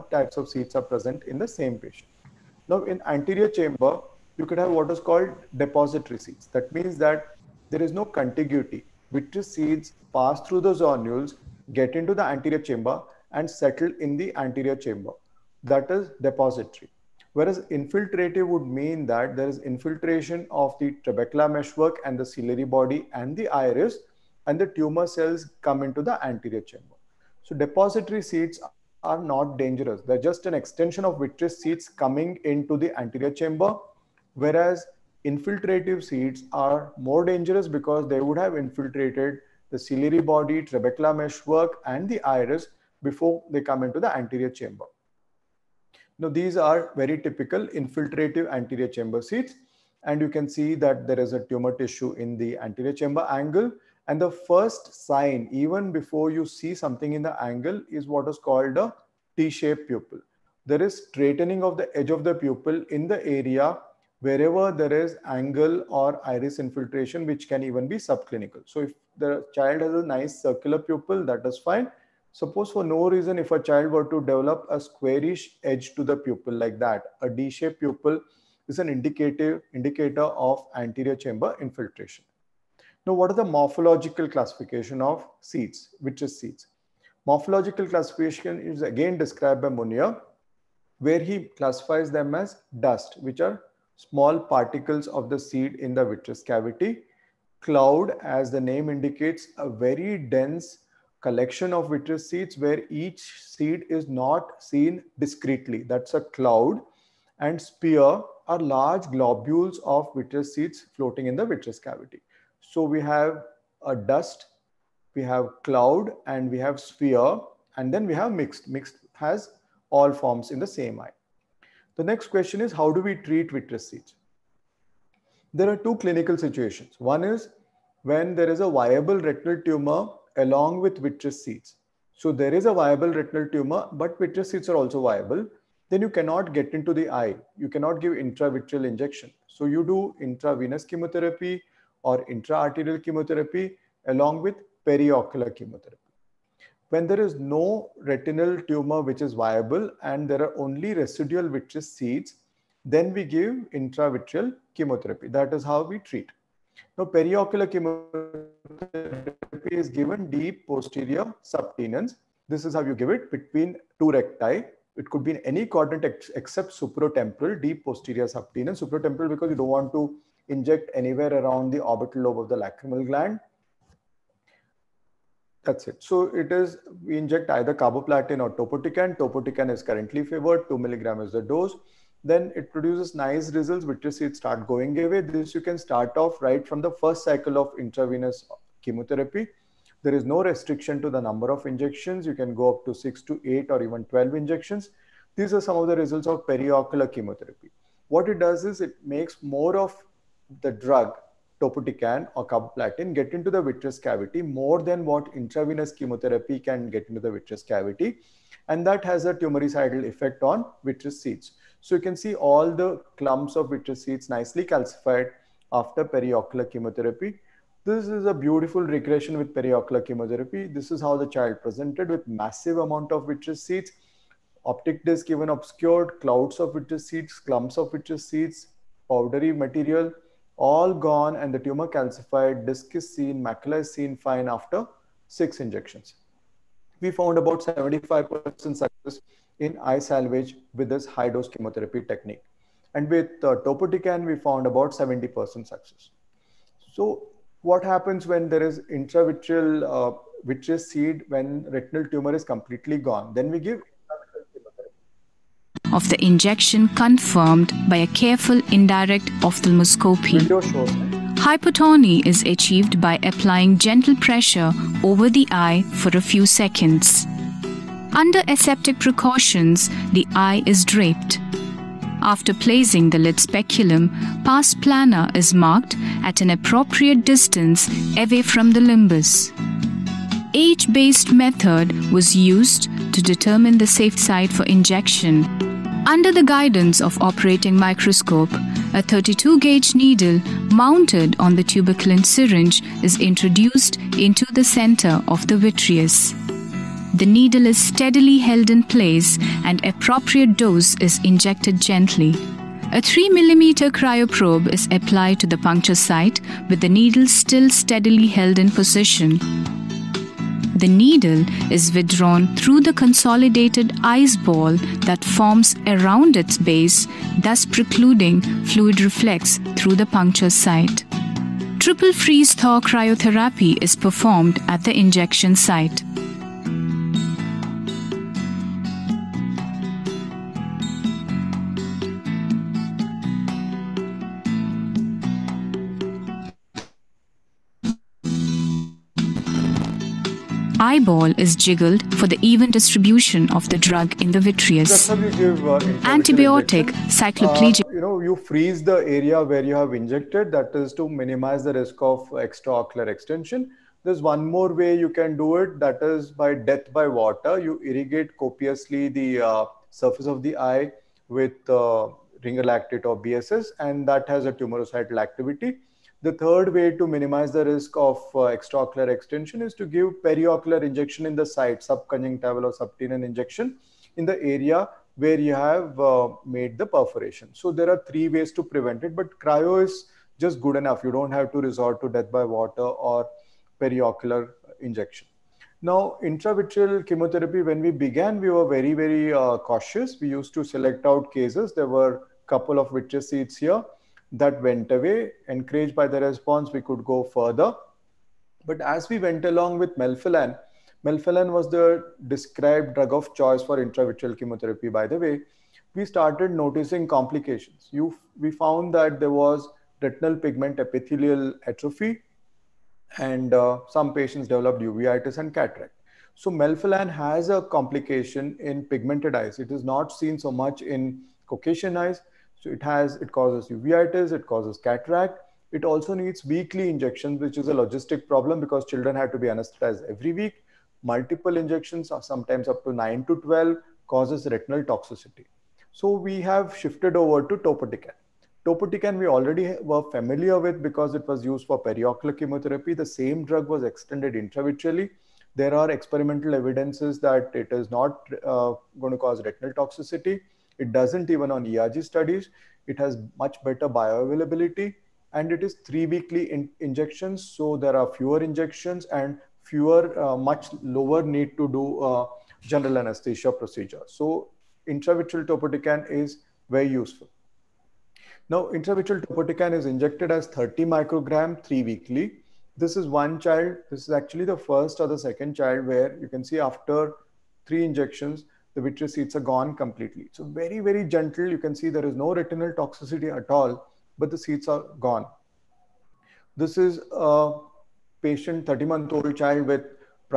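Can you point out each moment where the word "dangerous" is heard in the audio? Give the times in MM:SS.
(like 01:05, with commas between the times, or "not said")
00:29, 00:37.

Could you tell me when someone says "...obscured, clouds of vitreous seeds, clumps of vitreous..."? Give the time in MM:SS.
03:45.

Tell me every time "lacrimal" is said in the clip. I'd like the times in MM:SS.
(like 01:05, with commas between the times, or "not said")
02:52.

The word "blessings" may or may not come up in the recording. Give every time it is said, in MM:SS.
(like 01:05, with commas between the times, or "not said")
not said.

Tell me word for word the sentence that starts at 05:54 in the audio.
There's one more way you can do it, that is by death by water.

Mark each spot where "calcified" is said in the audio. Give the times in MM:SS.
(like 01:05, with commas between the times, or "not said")
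03:34, 03:51.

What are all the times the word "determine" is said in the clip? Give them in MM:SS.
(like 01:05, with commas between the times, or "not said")
04:43.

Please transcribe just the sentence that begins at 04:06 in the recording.
So what happens when there is intravitreal uh, vitreous seed when retinal tumor is completely gone?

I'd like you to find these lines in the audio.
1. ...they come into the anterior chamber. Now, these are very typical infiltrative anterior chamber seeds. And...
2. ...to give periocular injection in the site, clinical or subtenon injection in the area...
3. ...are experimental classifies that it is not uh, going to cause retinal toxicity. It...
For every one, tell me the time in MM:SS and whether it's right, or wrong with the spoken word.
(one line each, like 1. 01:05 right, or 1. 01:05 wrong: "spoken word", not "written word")
1. 00:43 right
2. 06:09 wrong: "subconjunctival", not "clinical"
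3. 07:25 wrong: "evidences", not "classifies".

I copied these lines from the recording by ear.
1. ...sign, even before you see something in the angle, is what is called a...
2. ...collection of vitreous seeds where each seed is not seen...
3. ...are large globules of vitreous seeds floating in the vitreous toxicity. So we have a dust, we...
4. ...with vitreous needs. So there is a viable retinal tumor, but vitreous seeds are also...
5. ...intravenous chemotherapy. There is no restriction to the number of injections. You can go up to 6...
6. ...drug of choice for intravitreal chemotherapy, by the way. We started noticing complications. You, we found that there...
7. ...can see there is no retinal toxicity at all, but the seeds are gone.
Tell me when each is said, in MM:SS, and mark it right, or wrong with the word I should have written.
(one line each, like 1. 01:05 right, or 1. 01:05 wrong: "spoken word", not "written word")
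1. 00:55 right
2. 01:41 right
3. 01:48 wrong: "cavity", not "toxicity"
4. 02:10 wrong: "seeds", not "needs"
5. 03:07 right
6. 06:42 right
7. 08:01 right.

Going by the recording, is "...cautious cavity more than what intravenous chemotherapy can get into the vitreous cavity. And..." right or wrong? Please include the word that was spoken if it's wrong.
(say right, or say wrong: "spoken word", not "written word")
wrong: "vitreous", not "cautious".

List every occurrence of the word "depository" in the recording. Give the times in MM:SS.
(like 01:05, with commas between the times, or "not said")
00:05, 00:16, 00:27.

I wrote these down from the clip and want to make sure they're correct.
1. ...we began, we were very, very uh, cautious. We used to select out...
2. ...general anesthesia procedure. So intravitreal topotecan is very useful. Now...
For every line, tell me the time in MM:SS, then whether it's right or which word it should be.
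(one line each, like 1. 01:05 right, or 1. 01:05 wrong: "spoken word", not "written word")
1. 06:27 right
2. 07:42 right.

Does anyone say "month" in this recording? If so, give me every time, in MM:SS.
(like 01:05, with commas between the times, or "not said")
08:08.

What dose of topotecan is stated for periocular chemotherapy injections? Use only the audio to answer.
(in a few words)
2 milligram.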